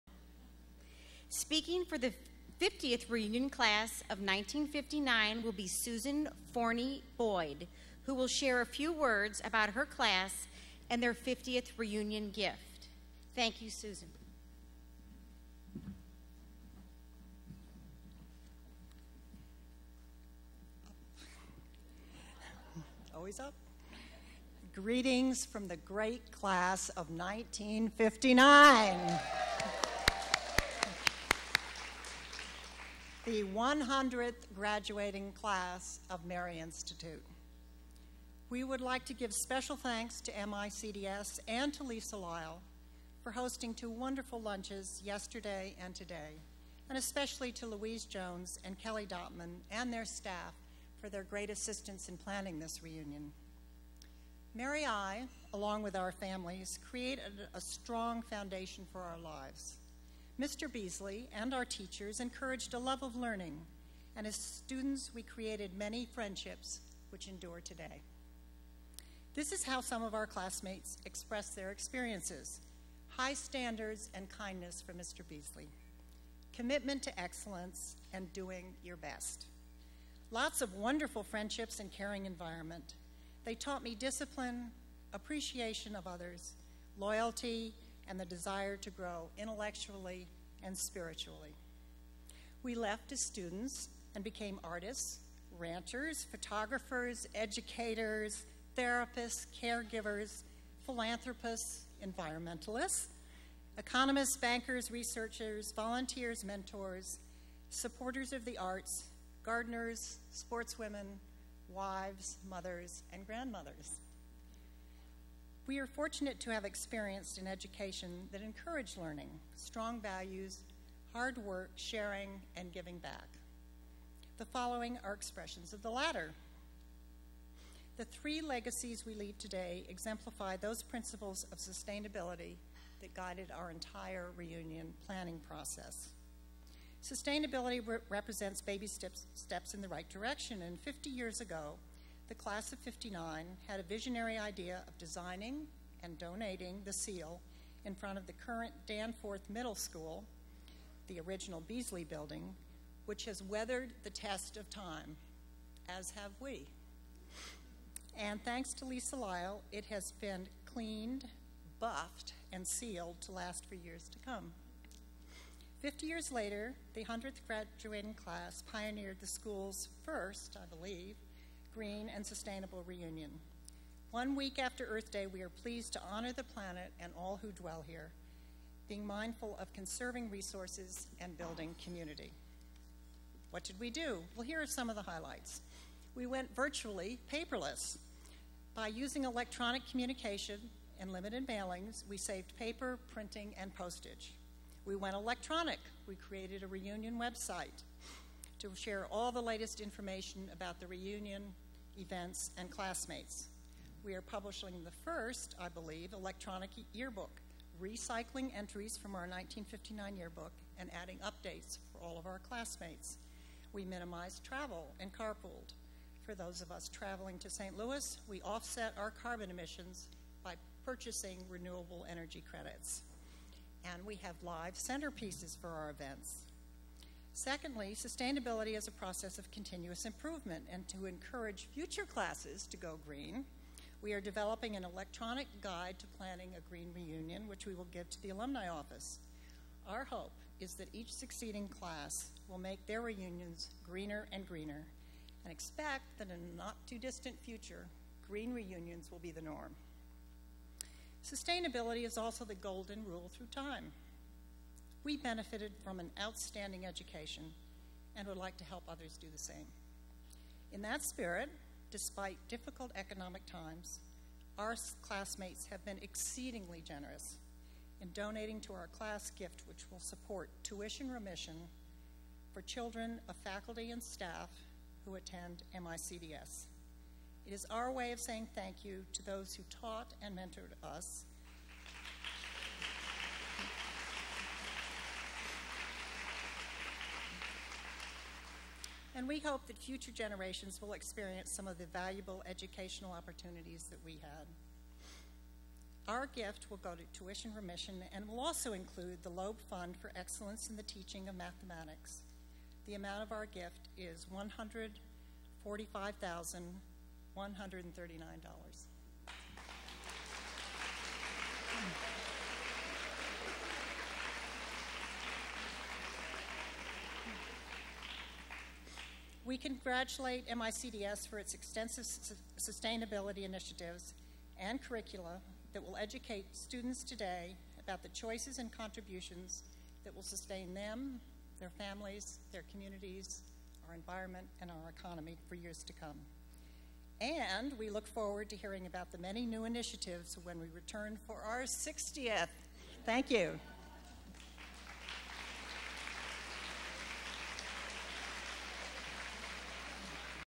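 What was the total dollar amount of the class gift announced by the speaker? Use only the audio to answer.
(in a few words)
$145,139.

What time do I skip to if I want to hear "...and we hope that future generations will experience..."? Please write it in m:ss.
4:49.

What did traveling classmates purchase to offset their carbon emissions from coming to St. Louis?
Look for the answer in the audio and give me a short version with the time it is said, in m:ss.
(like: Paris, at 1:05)
renewable energy credits, at 3:41.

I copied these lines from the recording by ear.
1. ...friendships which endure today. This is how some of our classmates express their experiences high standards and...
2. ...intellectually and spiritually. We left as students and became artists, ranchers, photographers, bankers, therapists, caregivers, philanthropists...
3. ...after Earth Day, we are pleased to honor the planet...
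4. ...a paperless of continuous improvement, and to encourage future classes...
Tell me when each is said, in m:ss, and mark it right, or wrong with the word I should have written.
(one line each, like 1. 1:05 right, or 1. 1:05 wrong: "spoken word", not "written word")
1. 1:06 right
2. 1:29 wrong: "educators", not "bankers"
3. 2:54 right
4. 3:48 wrong: "process", not "paperless".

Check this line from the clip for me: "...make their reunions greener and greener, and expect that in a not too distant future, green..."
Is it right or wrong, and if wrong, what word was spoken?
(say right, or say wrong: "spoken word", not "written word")
right.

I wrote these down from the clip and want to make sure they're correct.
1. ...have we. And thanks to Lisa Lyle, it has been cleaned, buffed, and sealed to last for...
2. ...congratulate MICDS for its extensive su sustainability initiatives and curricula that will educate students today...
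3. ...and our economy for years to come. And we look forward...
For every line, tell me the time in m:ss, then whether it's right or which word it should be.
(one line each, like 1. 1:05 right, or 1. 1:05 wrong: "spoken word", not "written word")
1. 2:36 right
2. 5:19 right
3. 5:34 right.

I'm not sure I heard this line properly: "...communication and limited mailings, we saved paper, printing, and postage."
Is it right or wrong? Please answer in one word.
right.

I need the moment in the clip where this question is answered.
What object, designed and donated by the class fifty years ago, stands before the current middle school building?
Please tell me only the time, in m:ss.
2:26.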